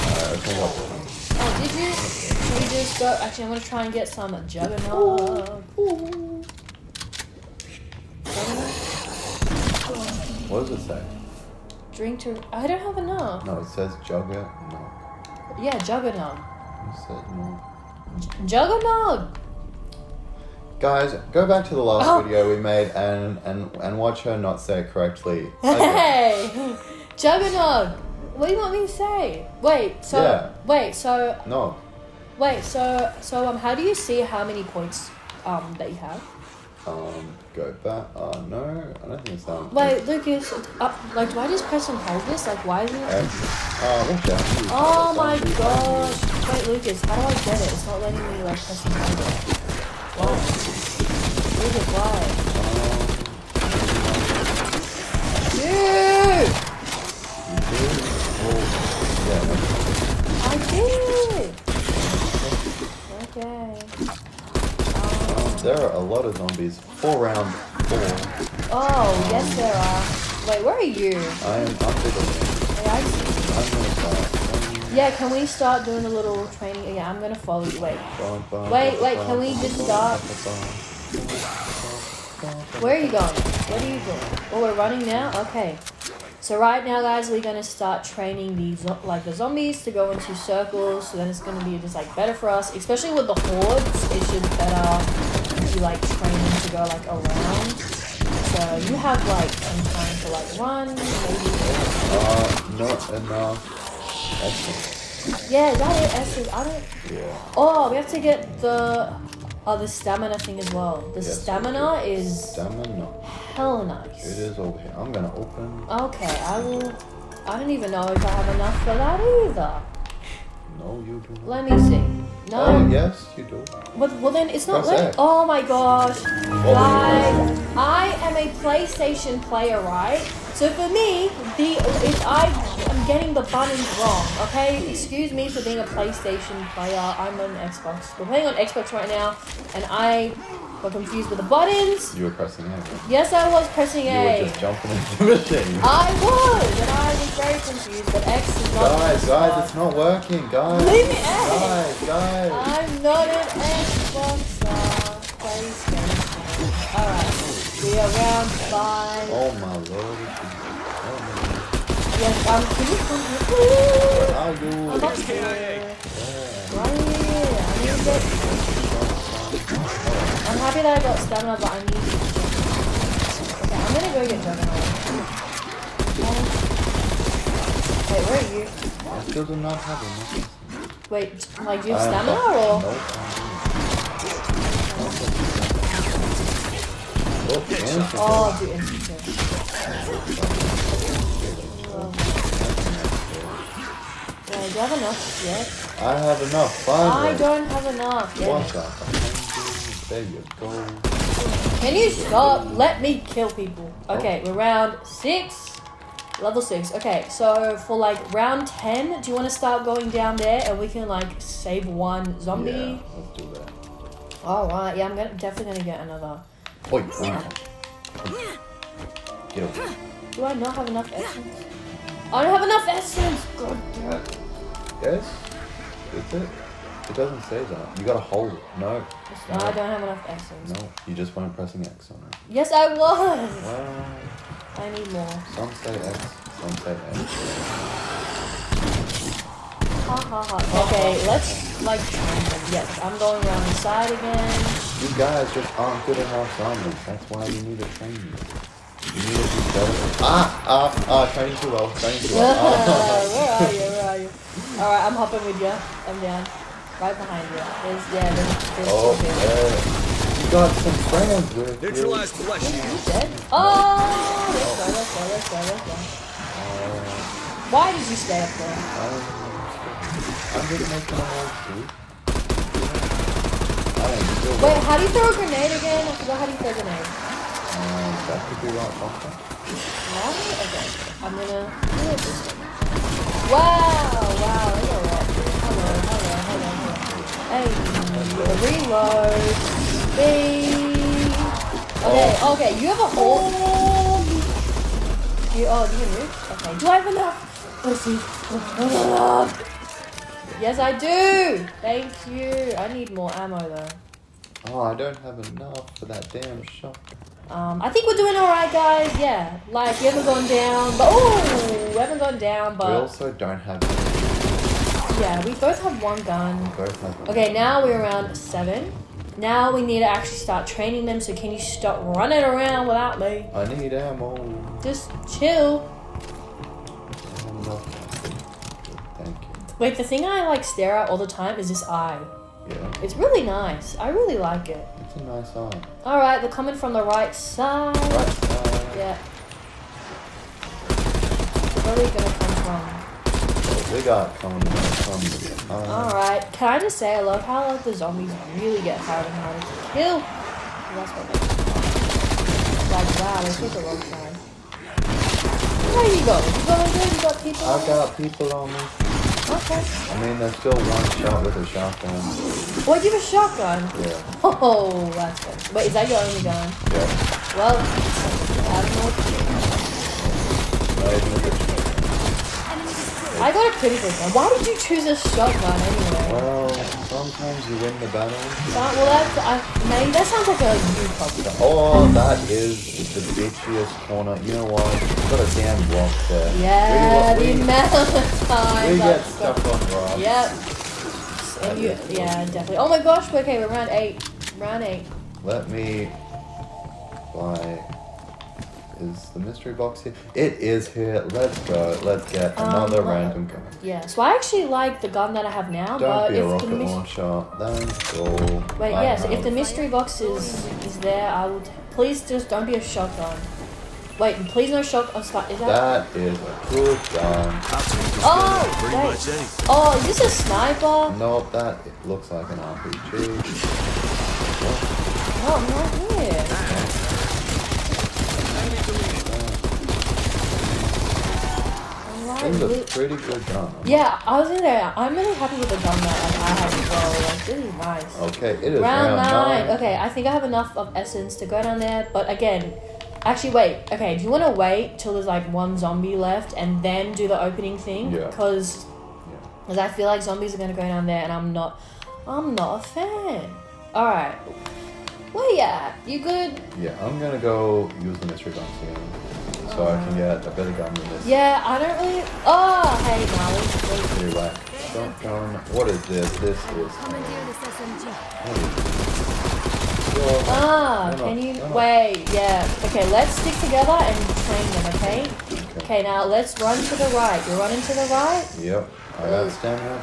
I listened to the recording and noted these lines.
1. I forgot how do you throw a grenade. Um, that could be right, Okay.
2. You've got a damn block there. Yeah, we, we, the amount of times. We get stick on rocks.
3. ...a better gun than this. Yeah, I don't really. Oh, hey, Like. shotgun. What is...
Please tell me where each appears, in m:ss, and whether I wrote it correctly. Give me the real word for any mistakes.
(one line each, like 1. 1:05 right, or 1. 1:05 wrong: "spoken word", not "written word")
1. 4:36 right
2. 6:25 wrong: "stuck", not "stick"
3. 7:40 wrong: "Molly", not "Like".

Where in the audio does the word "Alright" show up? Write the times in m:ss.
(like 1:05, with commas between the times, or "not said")
2:36, 4:14, 5:36, 5:45.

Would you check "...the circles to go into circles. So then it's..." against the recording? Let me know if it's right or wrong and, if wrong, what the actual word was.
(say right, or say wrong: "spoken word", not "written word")
wrong: "zombies", not "circles".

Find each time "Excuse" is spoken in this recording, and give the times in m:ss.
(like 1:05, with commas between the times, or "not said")
2:14.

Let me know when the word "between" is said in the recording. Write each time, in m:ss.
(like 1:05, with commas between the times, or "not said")
not said.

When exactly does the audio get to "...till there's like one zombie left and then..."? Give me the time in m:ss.
7:24.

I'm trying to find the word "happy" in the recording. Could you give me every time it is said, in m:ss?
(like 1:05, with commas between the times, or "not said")
2:42, 7:15.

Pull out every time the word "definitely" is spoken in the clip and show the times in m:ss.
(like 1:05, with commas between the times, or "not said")
3:35, 6:32.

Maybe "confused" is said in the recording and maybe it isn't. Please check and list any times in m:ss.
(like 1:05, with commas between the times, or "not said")
2:20, 2:27.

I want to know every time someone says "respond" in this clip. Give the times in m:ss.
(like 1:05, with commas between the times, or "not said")
not said.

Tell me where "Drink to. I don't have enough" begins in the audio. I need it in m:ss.
0:11.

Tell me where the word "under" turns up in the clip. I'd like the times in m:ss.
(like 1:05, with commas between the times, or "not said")
1:11.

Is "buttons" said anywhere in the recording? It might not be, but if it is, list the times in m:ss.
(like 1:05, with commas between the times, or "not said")
2:13, 2:21.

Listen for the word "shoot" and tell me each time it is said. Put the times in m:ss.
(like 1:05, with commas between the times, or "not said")
4:31.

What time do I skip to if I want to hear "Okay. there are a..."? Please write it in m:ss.
1:03.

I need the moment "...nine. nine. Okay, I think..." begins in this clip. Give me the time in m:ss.
7:19.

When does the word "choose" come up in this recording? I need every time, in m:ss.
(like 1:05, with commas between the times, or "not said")
6:14.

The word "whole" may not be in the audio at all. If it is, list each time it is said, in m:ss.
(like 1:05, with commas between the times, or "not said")
4:31, 4:53.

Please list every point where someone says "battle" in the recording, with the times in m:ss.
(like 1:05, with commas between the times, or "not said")
6:18.